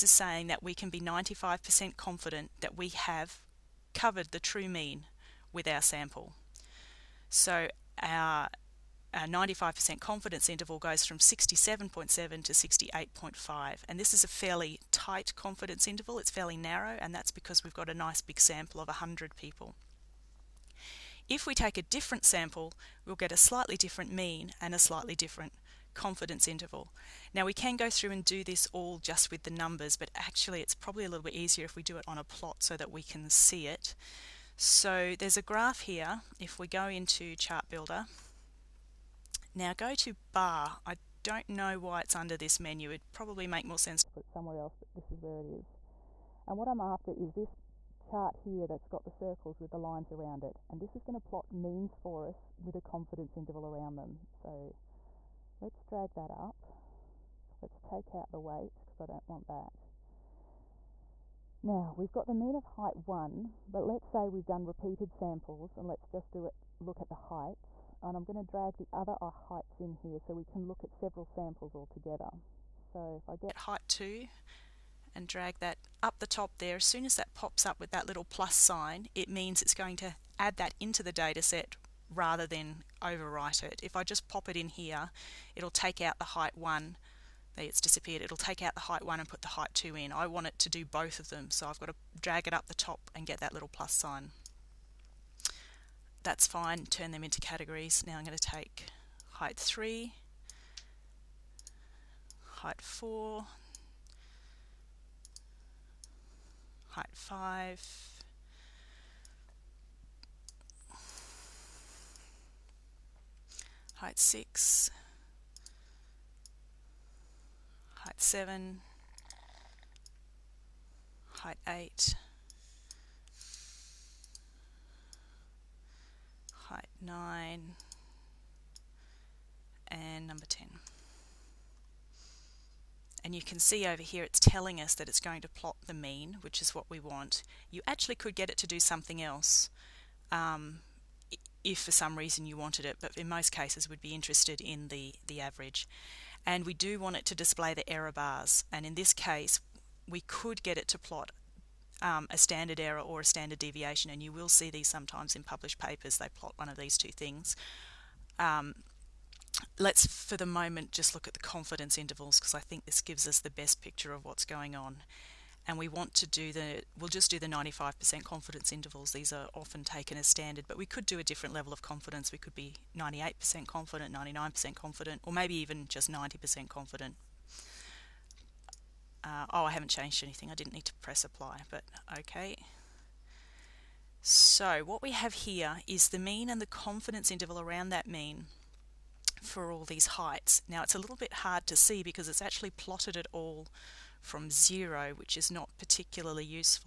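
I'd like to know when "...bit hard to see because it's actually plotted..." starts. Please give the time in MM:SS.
03:11.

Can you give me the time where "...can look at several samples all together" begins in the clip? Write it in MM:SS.
01:10.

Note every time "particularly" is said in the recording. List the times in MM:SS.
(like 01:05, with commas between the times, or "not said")
03:15.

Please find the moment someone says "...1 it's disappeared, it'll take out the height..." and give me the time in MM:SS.
01:26.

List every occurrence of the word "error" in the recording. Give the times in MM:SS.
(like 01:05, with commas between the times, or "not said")
02:27, 02:32.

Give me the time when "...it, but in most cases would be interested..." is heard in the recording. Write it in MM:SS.
02:22.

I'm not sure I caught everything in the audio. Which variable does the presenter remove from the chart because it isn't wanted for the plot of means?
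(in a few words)
weight.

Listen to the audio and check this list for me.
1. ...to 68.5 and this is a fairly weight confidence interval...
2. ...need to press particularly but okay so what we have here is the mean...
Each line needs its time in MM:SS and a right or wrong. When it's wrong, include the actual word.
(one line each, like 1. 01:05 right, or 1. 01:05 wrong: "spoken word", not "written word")
1. 00:12 wrong: "tight", not "weight"
2. 03:00 wrong: "apply", not "particularly".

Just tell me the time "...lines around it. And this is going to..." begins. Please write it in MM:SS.
00:49.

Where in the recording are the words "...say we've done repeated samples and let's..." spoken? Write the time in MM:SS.
01:04.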